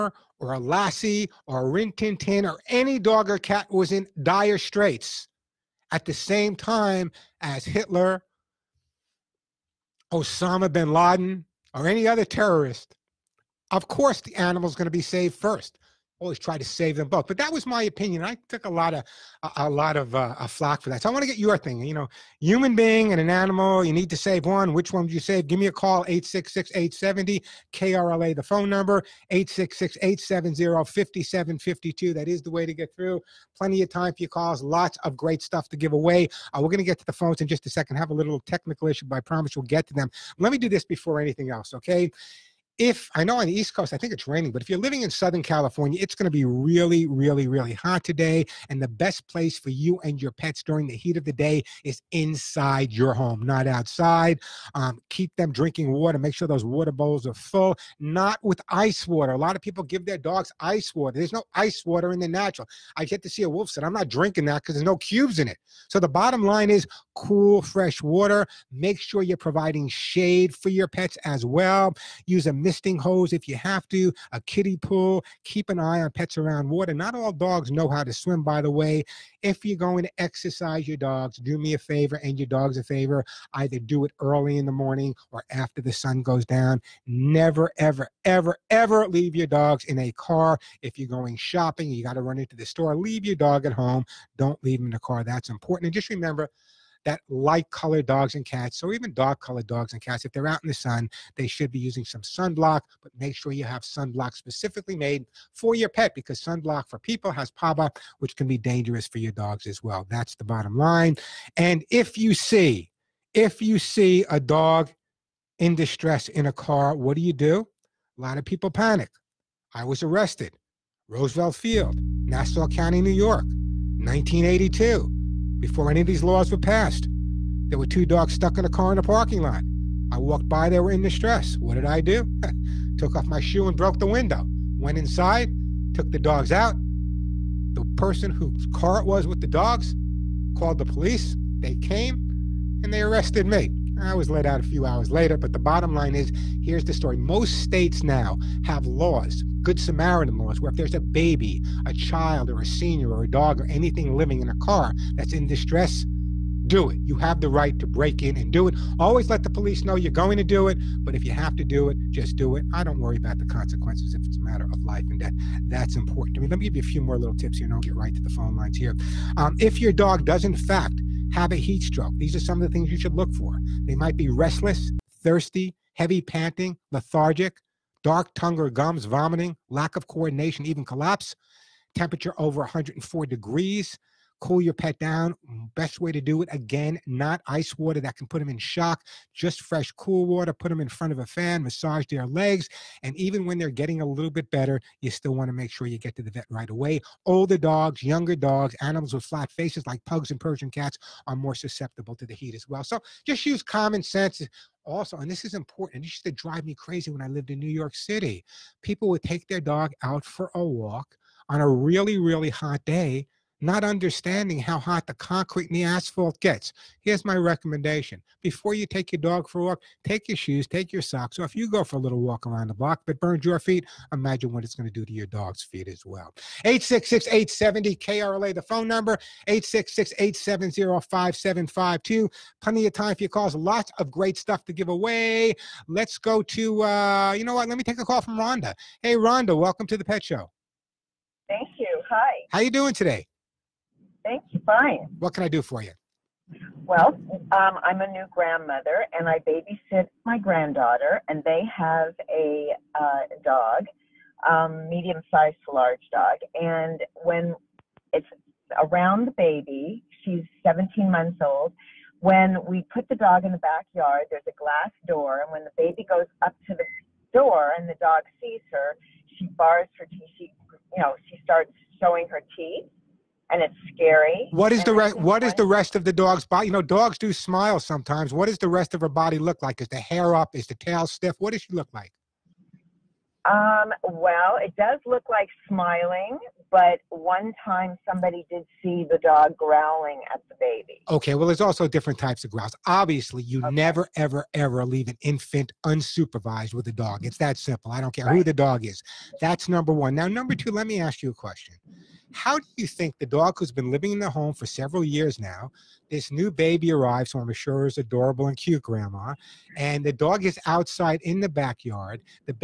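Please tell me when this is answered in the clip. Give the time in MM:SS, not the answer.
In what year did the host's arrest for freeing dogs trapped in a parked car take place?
02:03.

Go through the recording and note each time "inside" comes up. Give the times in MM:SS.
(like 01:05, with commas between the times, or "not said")
00:52, 02:14.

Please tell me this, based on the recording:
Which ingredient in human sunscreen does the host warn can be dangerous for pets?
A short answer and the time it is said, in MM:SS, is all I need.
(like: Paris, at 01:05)
PABA, at 01:47.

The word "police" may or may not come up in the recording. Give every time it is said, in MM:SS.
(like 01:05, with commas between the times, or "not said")
02:20, 02:39.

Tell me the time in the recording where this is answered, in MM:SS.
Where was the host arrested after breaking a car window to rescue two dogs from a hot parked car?
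02:01.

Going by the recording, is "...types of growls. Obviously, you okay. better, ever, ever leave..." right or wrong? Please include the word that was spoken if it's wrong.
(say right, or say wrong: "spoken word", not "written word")
wrong: "never", not "better".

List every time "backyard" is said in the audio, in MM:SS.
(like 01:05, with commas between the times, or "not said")
04:23, 05:11.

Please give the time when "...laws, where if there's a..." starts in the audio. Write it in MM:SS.
02:30.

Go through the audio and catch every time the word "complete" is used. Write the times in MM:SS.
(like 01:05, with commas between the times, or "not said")
not said.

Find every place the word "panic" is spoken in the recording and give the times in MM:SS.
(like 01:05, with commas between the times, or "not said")
01:58.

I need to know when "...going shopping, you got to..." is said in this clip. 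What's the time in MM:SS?
01:31.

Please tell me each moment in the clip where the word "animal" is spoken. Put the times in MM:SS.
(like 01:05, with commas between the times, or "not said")
00:14, 00:23, 03:18.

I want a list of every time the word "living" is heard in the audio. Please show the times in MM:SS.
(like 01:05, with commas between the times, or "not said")
00:44, 02:34, 05:03.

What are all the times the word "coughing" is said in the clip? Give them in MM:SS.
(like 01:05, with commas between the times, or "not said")
not said.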